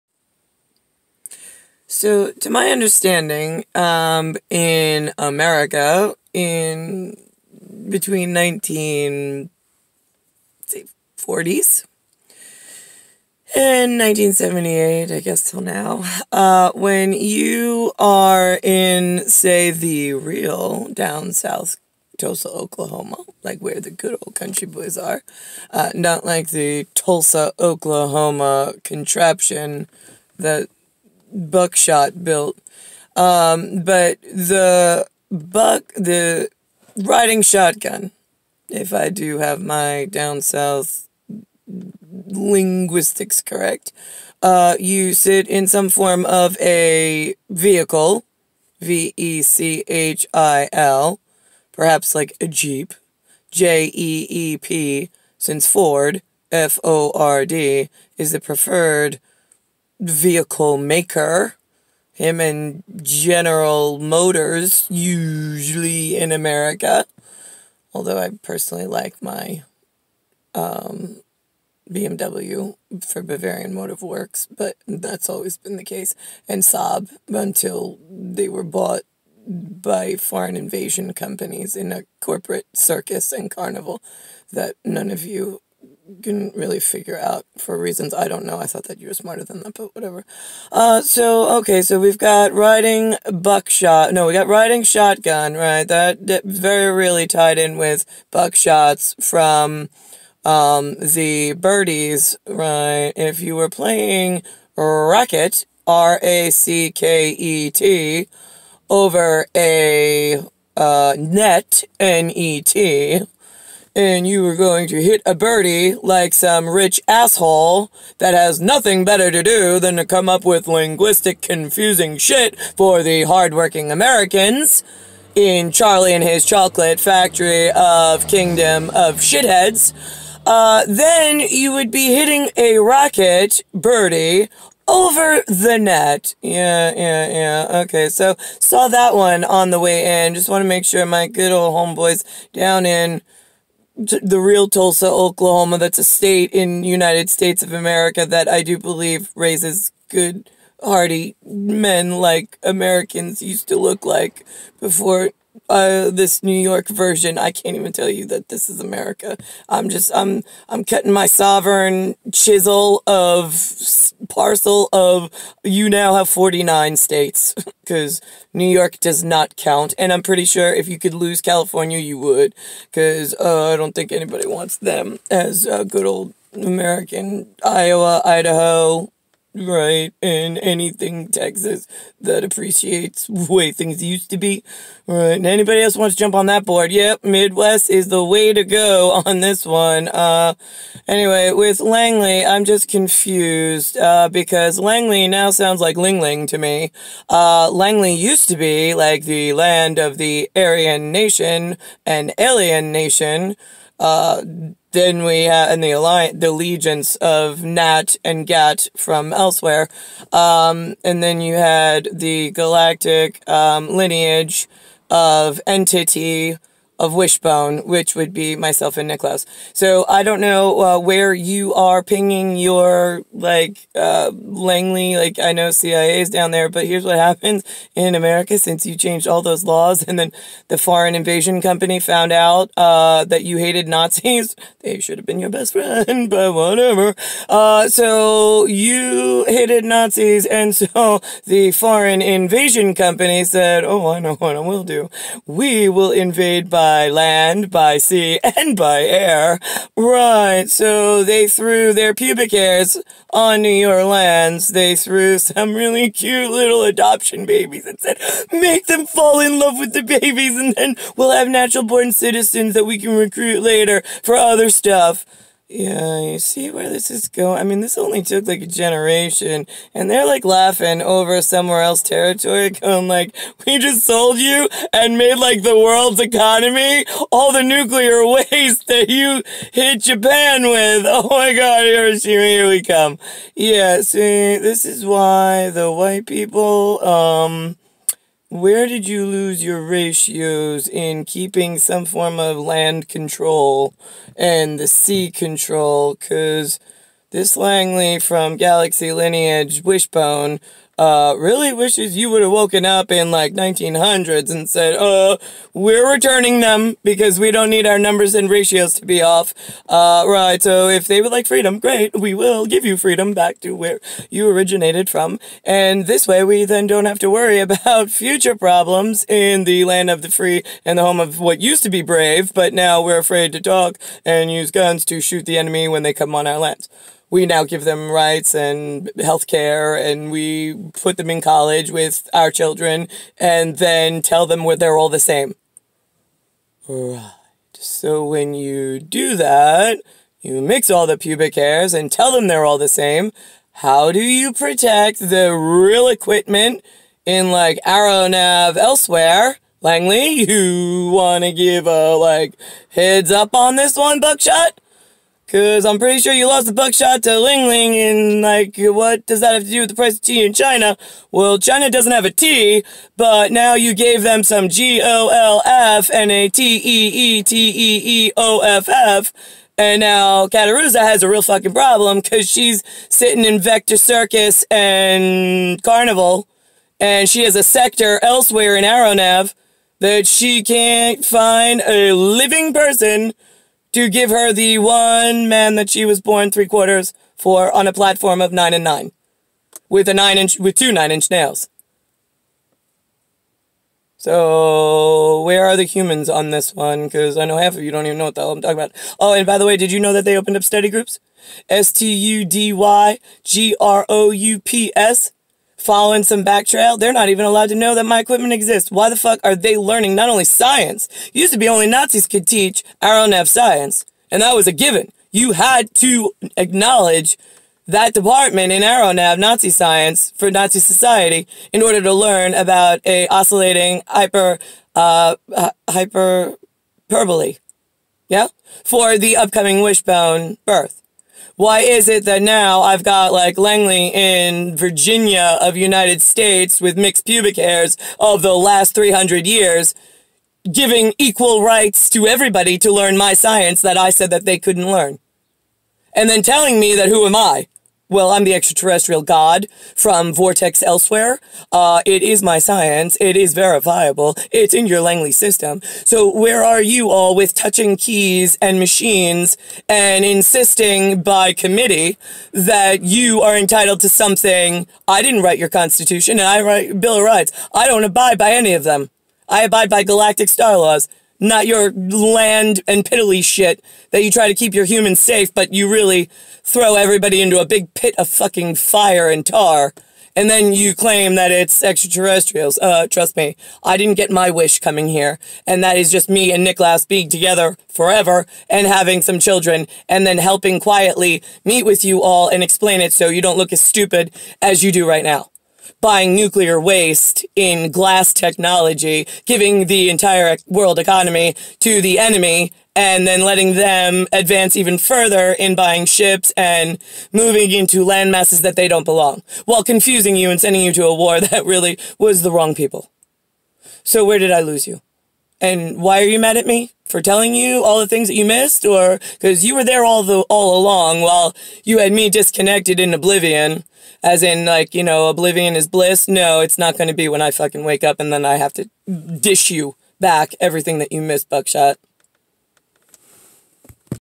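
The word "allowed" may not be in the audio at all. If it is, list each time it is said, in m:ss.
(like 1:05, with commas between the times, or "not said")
6:47.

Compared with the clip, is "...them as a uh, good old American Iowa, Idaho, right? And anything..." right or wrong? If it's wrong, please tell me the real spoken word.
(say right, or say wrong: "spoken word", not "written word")
right.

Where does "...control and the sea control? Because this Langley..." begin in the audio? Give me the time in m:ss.
4:53.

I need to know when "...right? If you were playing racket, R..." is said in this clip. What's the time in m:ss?
1:42.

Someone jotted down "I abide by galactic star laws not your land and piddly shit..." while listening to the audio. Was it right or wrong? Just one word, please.
right.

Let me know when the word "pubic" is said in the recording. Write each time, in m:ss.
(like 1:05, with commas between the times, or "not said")
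4:12, 5:41, 7:17.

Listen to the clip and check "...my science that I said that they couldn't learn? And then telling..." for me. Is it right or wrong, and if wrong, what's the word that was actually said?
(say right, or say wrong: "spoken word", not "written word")
right.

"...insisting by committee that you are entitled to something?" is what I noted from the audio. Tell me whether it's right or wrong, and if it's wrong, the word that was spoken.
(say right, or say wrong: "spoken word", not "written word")
right.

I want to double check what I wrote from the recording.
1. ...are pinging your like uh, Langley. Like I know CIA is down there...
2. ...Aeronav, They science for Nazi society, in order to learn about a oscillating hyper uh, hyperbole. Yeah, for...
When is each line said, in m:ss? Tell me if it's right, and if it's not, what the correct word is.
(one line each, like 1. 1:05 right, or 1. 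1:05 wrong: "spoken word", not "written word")
1. 3:41 right
2. 6:58 wrong: "Nazi", not "They".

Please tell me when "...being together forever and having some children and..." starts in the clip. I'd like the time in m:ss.
8:07.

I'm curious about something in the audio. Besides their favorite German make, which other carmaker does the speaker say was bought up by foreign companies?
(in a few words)
Saab.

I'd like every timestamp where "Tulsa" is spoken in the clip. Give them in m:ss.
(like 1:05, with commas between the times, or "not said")
0:22, 0:26, 2:24.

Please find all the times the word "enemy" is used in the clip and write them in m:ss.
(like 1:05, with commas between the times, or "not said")
5:25, 8:22.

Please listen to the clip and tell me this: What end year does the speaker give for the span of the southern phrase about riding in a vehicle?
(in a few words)
1978.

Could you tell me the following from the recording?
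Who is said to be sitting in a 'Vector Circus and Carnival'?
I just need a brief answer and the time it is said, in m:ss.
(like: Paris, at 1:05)
Cattaruzza, at 6:10.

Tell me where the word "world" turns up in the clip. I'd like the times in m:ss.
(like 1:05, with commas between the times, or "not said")
4:35, 8:20.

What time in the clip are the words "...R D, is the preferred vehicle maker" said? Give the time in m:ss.
0:57.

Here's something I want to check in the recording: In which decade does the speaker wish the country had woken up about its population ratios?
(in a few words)
1900s.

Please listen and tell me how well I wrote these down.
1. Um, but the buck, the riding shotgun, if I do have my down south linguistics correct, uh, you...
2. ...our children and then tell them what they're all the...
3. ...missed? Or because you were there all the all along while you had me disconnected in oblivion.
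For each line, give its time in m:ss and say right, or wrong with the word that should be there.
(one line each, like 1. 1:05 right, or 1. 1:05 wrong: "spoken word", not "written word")
1. 0:33 right
2. 5:32 right
3. 8:38 right.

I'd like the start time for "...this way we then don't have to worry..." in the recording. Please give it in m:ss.
5:16.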